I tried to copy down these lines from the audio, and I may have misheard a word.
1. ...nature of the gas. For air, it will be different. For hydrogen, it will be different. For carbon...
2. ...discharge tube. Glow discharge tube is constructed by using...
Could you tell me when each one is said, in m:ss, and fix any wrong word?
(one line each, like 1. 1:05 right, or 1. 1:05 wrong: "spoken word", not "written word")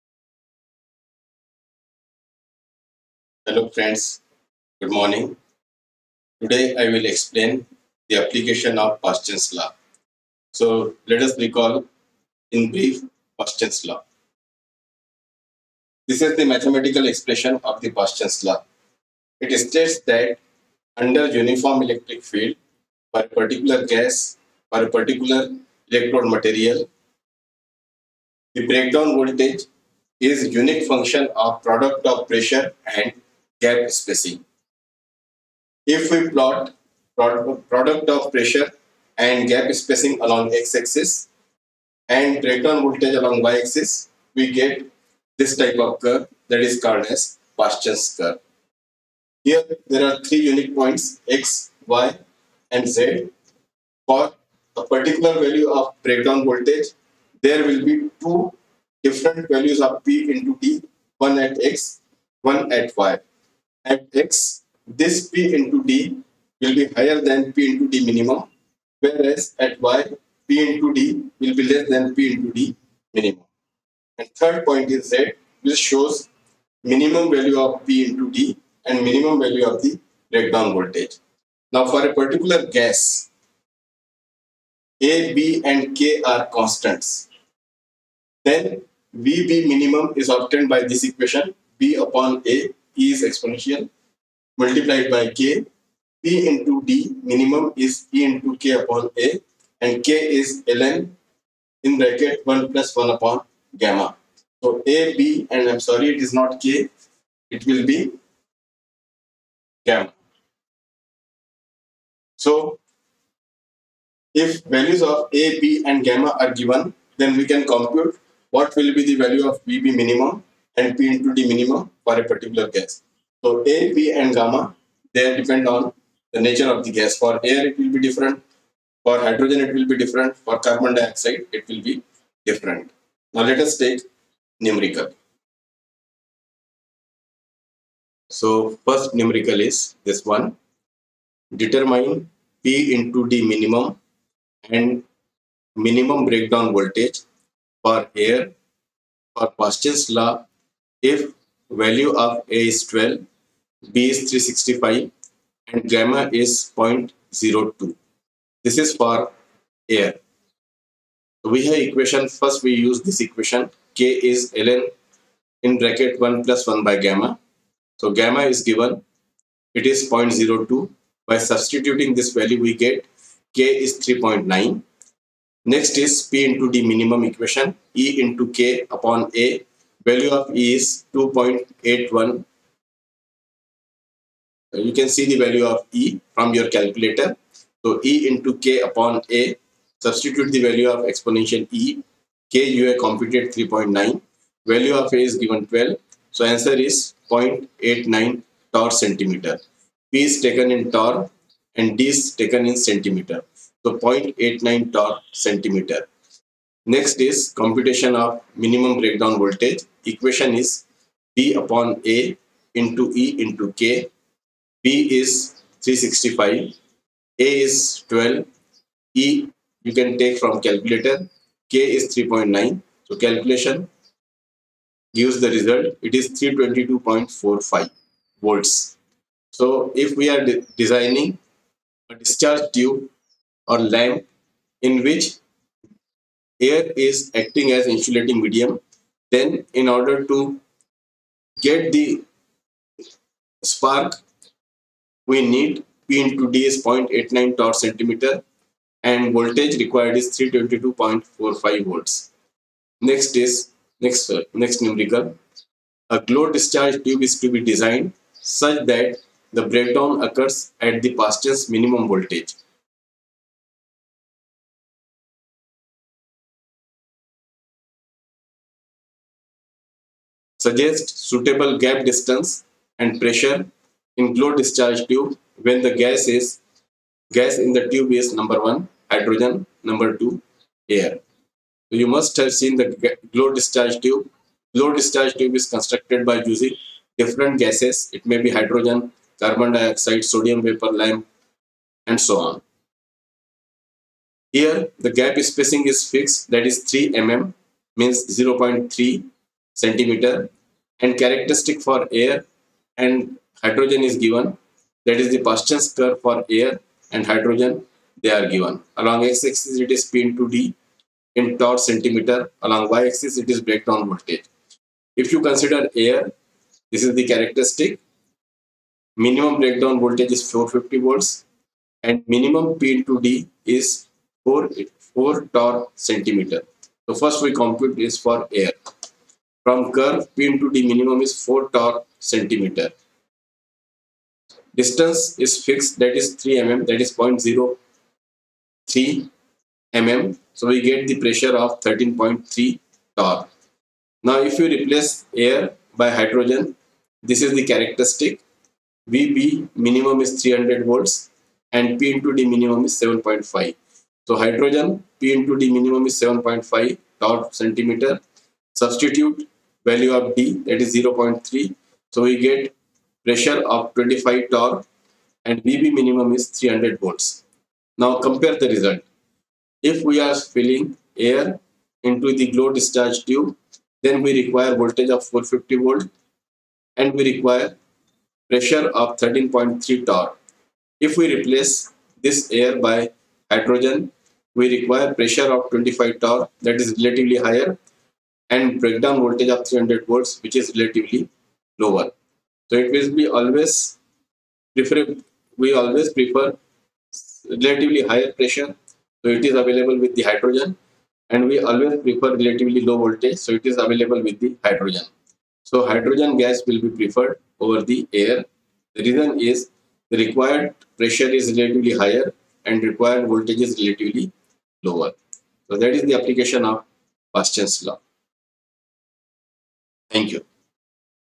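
1. 2:06 right
2. 4:43 right.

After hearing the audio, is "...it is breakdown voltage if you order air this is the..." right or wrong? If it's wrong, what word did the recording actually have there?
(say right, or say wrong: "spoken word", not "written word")
wrong: "consider", not "order".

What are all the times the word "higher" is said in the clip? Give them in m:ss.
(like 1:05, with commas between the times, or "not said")
1:06, 6:27, 6:38, 6:52.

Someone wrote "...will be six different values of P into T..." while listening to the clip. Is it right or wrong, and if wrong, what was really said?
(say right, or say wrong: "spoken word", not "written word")
wrong: "two", not "six".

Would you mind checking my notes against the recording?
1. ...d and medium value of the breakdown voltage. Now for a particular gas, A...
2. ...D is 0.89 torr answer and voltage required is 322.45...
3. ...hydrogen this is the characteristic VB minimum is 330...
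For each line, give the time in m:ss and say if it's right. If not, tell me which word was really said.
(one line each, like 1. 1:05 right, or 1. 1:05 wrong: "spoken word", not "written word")
1. 1:18 wrong: "minimum", not "medium"
2. 4:06 wrong: "centimeter", not "answer"
3. 5:46 wrong: "300", not "330".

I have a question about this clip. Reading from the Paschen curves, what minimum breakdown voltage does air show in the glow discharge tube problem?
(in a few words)
450 volts.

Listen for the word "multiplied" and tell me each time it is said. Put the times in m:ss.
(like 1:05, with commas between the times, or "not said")
1:34.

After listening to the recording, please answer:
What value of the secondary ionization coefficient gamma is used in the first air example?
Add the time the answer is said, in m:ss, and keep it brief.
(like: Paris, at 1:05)
0.02, at 2:35.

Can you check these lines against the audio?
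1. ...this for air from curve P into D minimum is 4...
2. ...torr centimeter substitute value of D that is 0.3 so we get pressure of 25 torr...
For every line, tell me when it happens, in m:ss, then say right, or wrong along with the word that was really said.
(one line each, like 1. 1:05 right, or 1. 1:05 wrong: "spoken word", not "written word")
1. 5:28 right
2. 5:57 right.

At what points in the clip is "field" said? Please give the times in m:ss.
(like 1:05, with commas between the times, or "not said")
0:22.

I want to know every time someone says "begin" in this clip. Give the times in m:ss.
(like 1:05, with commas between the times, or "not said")
not said.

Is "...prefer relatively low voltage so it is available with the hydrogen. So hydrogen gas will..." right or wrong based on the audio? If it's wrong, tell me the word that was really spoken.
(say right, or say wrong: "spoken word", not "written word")
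right.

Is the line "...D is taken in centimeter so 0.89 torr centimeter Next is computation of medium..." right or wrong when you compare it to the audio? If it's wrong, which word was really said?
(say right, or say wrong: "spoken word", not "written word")
wrong: "minimum", not "medium".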